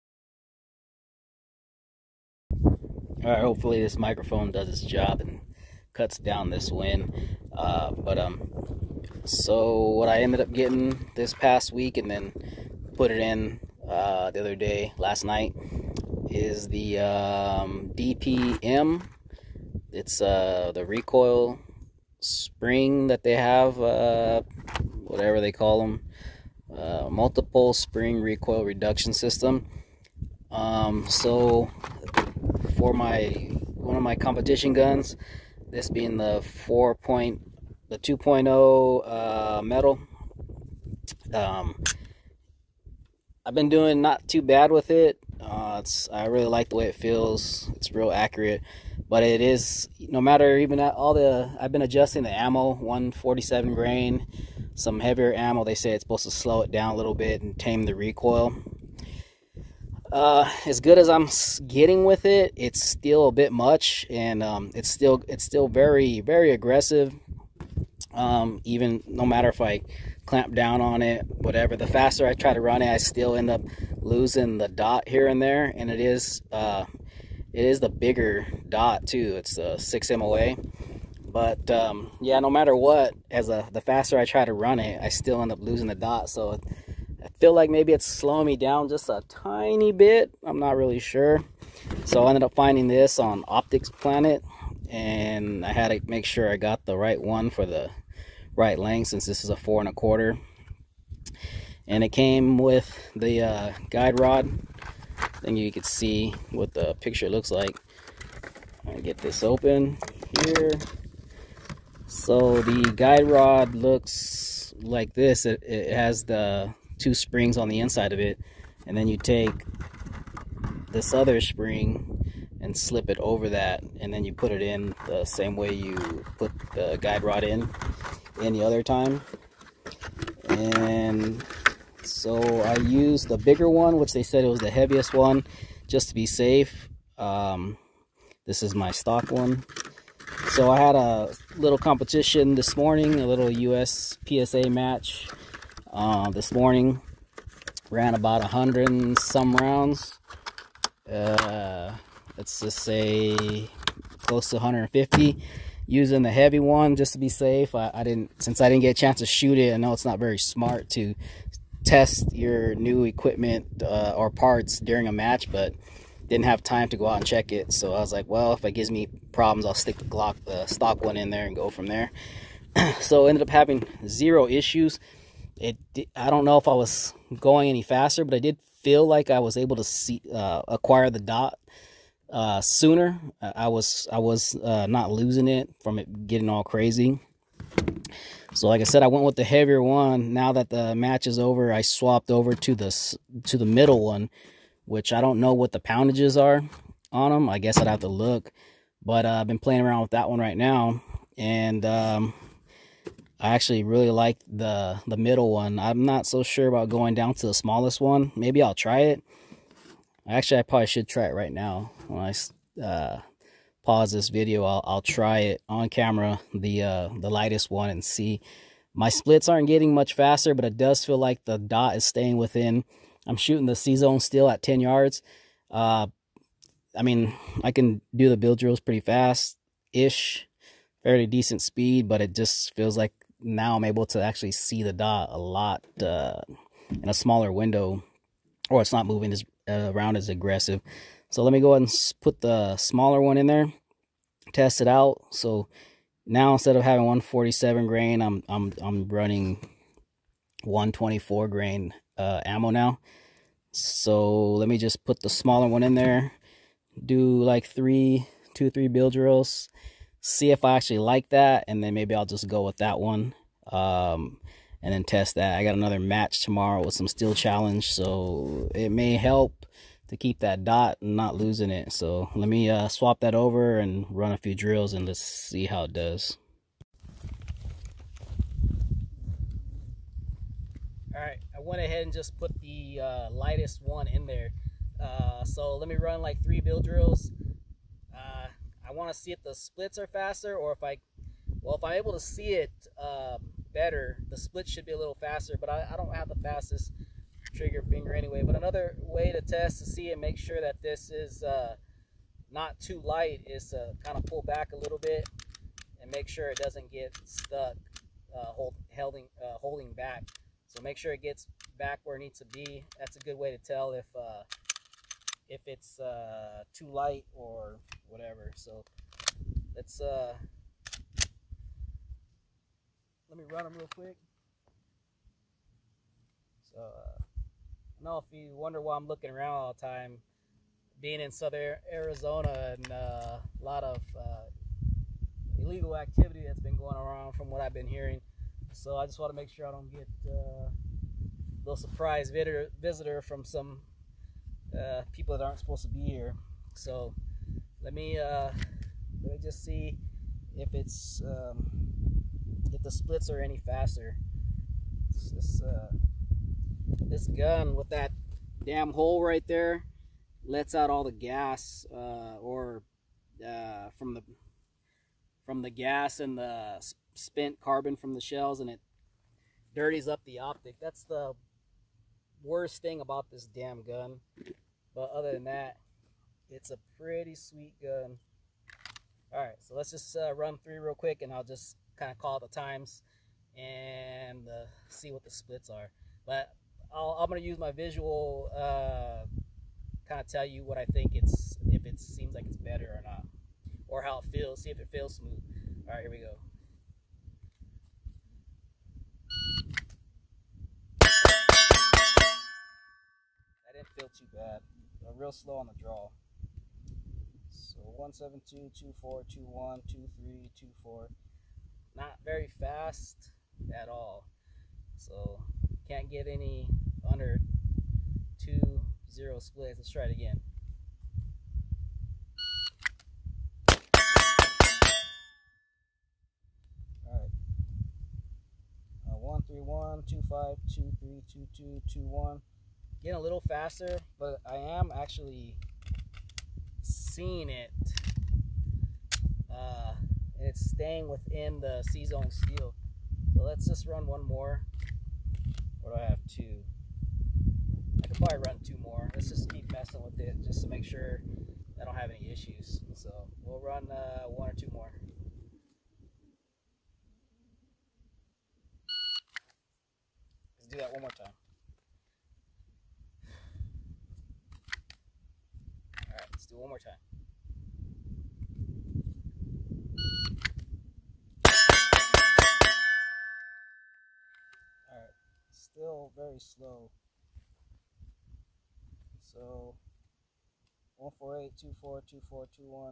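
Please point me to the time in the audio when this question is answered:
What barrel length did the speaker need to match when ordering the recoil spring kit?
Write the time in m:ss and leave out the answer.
1:39.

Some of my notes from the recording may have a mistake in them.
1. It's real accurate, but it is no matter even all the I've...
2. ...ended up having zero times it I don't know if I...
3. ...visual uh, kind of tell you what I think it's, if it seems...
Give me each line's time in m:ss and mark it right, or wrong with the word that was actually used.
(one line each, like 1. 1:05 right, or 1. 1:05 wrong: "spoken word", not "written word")
1. 0:47 right
2. 2:53 wrong: "issues", not "times"
3. 6:27 right.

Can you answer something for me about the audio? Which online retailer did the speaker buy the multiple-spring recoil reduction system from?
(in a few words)
Optics Planet.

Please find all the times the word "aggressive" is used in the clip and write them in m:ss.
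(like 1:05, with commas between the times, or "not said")
1:06, 4:00.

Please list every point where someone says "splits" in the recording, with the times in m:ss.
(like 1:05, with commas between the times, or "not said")
3:39, 4:49, 4:54, 5:52, 6:25, 6:59.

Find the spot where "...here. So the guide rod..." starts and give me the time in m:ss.
1:50.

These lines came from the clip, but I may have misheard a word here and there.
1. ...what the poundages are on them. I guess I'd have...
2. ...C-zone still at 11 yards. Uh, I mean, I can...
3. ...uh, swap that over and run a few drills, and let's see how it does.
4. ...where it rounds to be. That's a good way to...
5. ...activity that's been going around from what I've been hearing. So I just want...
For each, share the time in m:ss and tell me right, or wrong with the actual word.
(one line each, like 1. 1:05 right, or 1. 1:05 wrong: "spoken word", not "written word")
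1. 3:15 right
2. 3:43 wrong: "10", not "11"
3. 4:32 right
4. 5:12 wrong: "needs", not "rounds"
5. 5:35 right.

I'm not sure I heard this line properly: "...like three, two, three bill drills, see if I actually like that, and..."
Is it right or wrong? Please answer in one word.
right.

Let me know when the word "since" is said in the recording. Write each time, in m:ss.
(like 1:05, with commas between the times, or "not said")
1:39, 2:38.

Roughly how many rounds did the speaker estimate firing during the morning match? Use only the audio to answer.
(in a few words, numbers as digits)
150.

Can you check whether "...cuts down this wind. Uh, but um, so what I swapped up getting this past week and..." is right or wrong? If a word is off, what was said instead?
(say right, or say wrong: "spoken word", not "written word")
wrong: "ended", not "swapped".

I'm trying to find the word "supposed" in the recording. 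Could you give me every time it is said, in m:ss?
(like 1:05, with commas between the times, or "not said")
0:56, 5:45.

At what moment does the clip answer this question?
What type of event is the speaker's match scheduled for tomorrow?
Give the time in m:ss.
4:27.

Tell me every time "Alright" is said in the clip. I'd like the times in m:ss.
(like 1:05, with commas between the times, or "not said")
7:07, 7:54.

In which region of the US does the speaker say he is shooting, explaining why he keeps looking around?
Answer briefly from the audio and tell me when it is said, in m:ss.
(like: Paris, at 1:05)
Southern Arizona, at 5:31.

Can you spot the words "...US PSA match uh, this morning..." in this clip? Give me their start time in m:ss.
2:23.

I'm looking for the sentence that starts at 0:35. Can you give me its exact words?
This being the four point, the 2.0 uh, metal.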